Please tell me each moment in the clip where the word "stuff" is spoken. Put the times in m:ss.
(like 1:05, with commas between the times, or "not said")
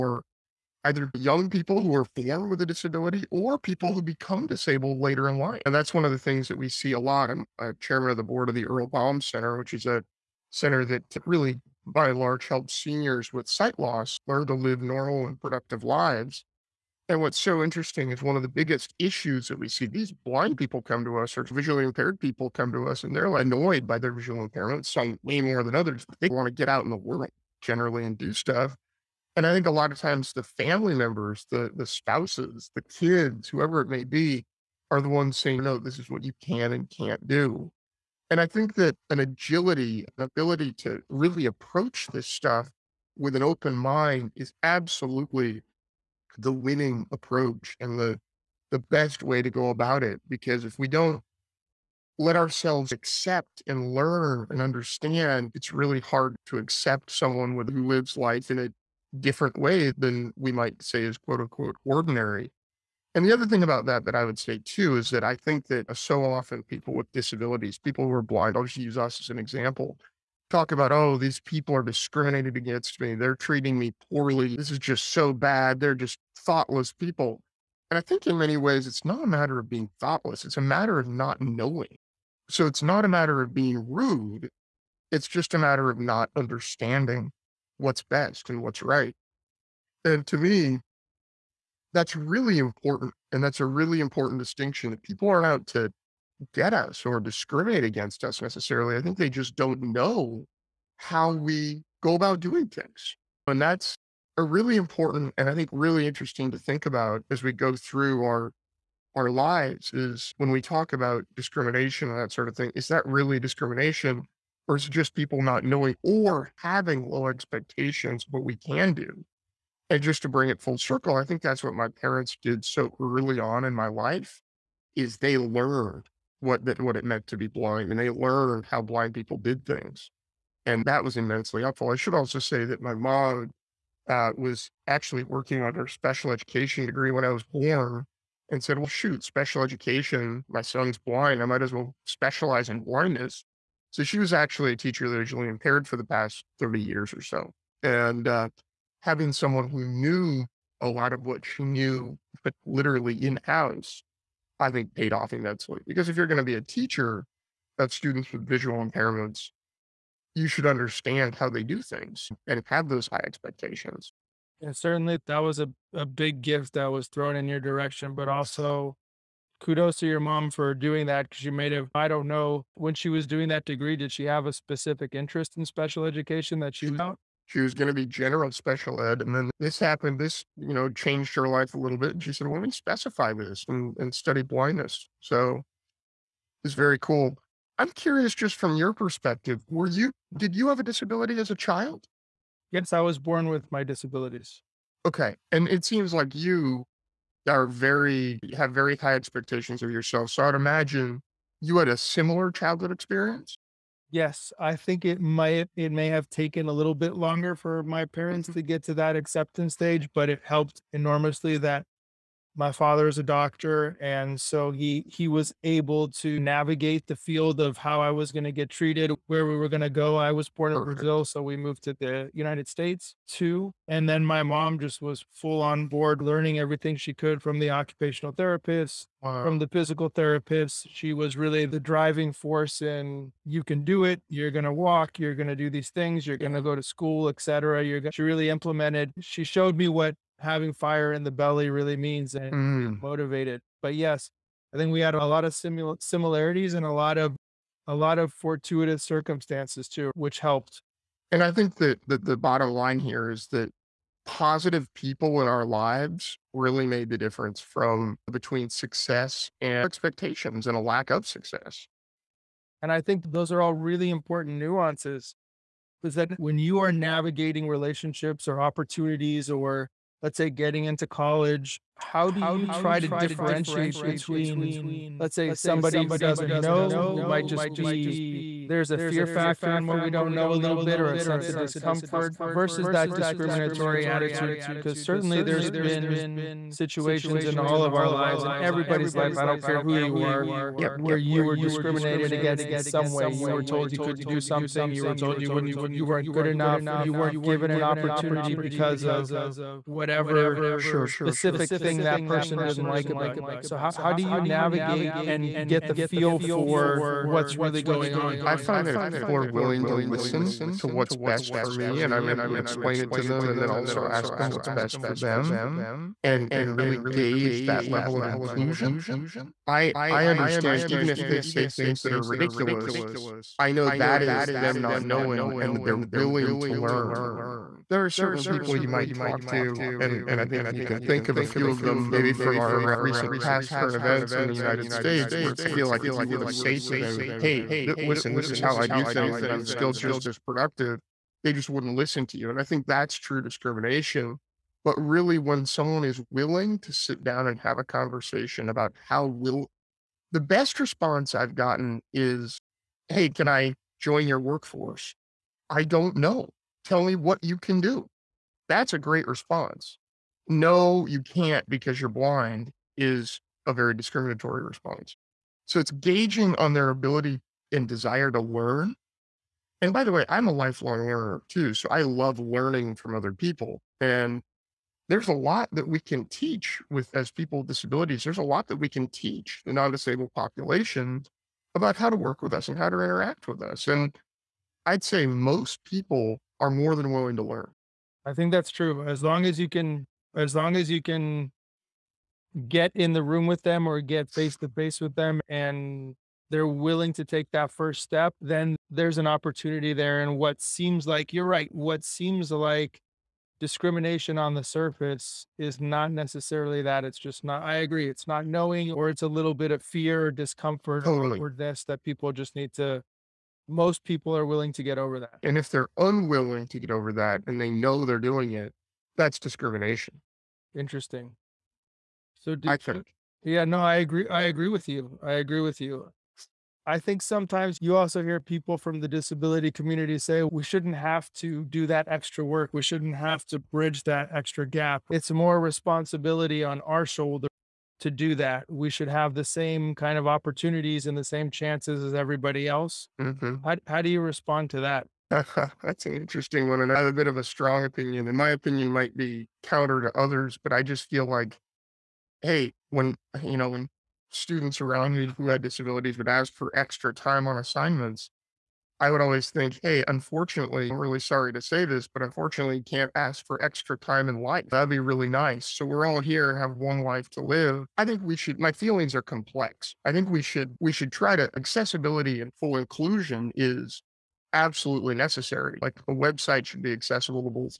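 0:28, 0:42.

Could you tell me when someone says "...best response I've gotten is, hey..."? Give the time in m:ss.
5:50.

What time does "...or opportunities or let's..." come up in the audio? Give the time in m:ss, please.
4:28.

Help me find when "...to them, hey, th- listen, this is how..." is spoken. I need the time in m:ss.
5:36.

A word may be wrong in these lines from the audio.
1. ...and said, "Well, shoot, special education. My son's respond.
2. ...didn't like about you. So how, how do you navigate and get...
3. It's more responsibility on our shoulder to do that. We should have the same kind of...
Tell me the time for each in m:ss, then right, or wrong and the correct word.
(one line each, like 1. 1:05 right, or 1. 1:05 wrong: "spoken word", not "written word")
1. 2:18 wrong: "blind", not "respond"
2. 5:02 right
3. 7:15 right.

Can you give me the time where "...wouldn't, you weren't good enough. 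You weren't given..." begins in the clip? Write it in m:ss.
4:55.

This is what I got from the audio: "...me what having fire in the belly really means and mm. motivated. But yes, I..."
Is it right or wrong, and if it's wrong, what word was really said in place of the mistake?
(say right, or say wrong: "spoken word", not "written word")
right.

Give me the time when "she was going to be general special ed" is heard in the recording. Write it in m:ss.
2:57.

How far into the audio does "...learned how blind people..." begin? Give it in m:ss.
2:08.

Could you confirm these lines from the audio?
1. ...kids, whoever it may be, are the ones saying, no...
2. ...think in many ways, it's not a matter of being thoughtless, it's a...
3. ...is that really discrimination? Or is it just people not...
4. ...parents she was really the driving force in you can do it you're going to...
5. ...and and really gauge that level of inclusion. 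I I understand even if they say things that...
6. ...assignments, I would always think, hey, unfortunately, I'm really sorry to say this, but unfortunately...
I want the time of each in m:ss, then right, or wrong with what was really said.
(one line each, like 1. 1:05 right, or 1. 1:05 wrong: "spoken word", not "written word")
1. 0:32 right
2. 1:18 right
3. 1:52 right
4. 3:50 wrong: "therapists", not "parents"
5. 5:16 right
6. 7:37 right.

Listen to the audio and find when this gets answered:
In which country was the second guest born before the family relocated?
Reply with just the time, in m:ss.
3:40.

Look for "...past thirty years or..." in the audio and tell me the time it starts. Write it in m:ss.
2:26.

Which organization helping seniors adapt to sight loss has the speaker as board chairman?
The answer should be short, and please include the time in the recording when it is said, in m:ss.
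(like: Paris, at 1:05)
Earle Baum Center, at 0:08.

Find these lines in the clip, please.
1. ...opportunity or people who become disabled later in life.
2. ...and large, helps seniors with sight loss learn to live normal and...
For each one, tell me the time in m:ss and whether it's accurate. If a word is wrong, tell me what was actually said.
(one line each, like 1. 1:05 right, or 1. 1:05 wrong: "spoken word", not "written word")
1. 0:02 wrong: "disability", not "opportunity"
2. 0:12 right.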